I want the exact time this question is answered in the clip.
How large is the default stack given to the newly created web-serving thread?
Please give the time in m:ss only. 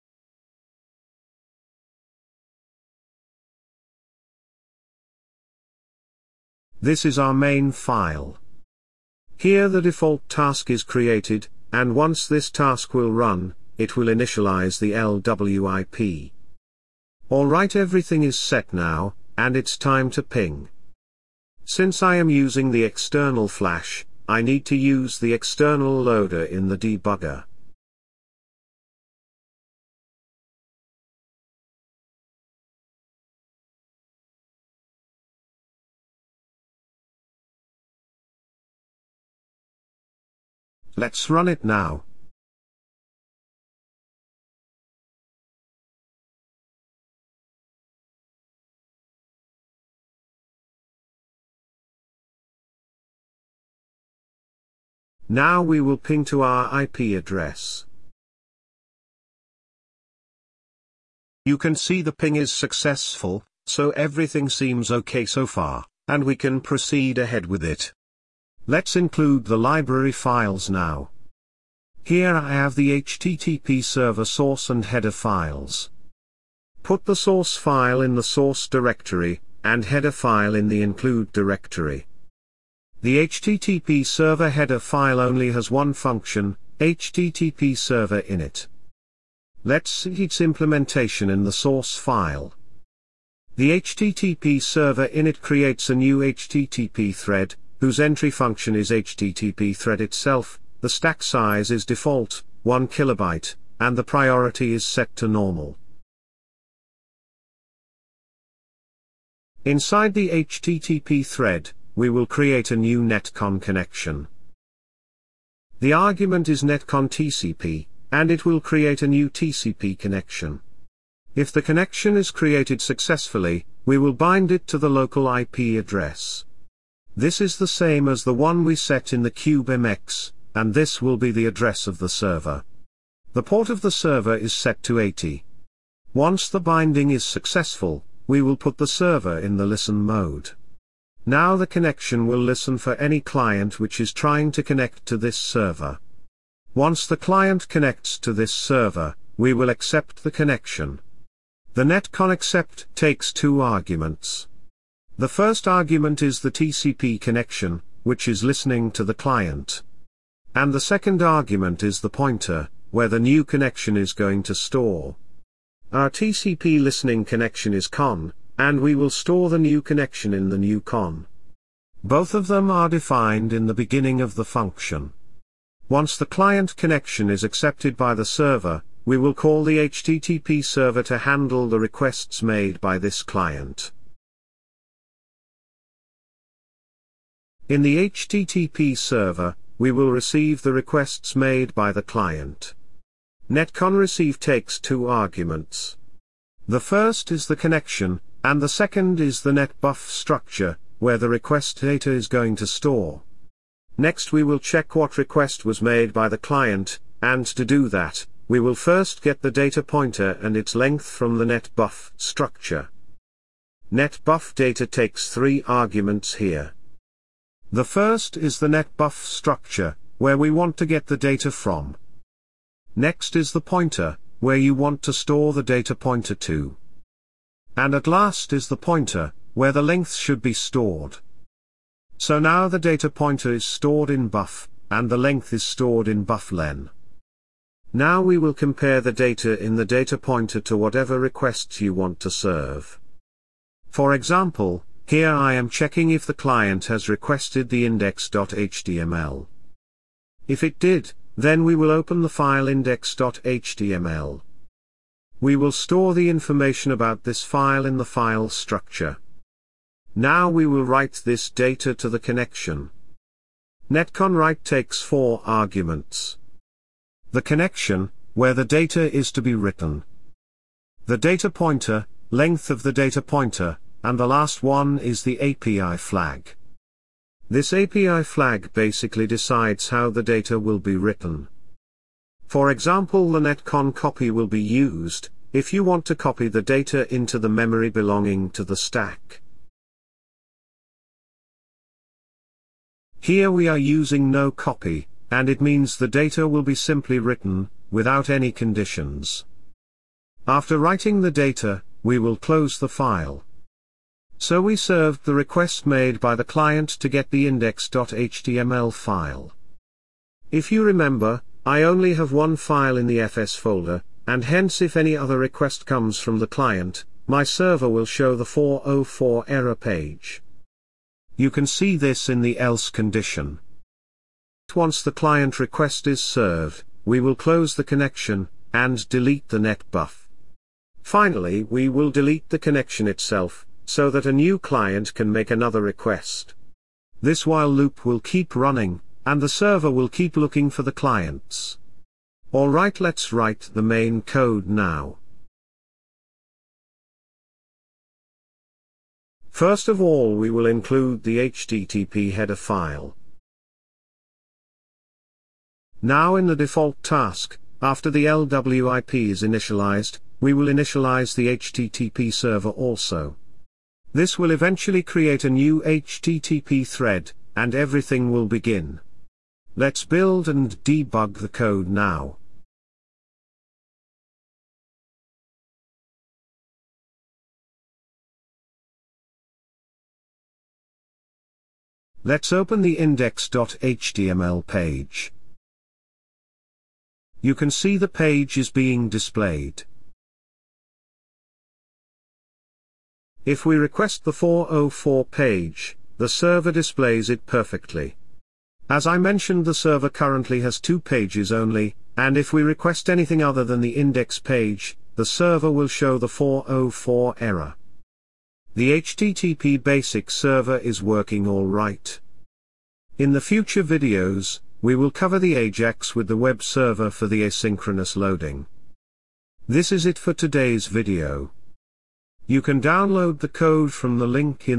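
1:42.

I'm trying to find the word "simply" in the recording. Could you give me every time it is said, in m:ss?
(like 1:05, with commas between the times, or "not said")
4:56.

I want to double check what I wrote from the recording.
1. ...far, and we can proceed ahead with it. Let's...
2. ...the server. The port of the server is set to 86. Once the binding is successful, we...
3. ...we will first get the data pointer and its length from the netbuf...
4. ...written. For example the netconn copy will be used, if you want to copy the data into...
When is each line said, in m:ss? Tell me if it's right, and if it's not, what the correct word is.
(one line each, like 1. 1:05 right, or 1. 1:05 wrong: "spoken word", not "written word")
1. 1:05 right
2. 2:11 wrong: "80", not "86"
3. 3:28 right
4. 4:40 right.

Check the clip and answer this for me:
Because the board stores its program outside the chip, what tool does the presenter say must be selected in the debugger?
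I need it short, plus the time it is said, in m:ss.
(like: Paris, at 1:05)
external loader, at 0:25.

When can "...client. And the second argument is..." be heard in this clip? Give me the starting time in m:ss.
2:39.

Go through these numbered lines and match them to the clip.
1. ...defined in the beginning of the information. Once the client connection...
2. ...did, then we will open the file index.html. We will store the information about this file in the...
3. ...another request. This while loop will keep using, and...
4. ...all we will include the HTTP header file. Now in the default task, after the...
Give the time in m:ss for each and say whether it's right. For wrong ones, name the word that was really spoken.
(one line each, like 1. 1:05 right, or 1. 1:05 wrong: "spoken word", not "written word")
1. 2:52 wrong: "function", not "information"
2. 4:10 right
3. 5:35 wrong: "running", not "using"
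4. 5:49 right.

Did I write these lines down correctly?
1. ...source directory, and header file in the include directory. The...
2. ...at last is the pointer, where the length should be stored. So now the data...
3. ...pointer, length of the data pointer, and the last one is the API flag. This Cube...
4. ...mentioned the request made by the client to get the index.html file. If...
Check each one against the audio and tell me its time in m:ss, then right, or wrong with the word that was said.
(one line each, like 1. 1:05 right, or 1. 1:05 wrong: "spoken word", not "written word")
1. 1:18 right
2. 3:47 right
3. 4:31 wrong: "API", not "Cube"
4. 5:04 wrong: "served", not "mentioned".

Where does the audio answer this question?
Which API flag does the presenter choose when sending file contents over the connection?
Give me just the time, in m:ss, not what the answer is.
4:54.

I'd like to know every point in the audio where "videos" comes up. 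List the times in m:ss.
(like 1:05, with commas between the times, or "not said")
6:53, 7:00.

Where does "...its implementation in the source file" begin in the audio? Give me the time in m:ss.
1:30.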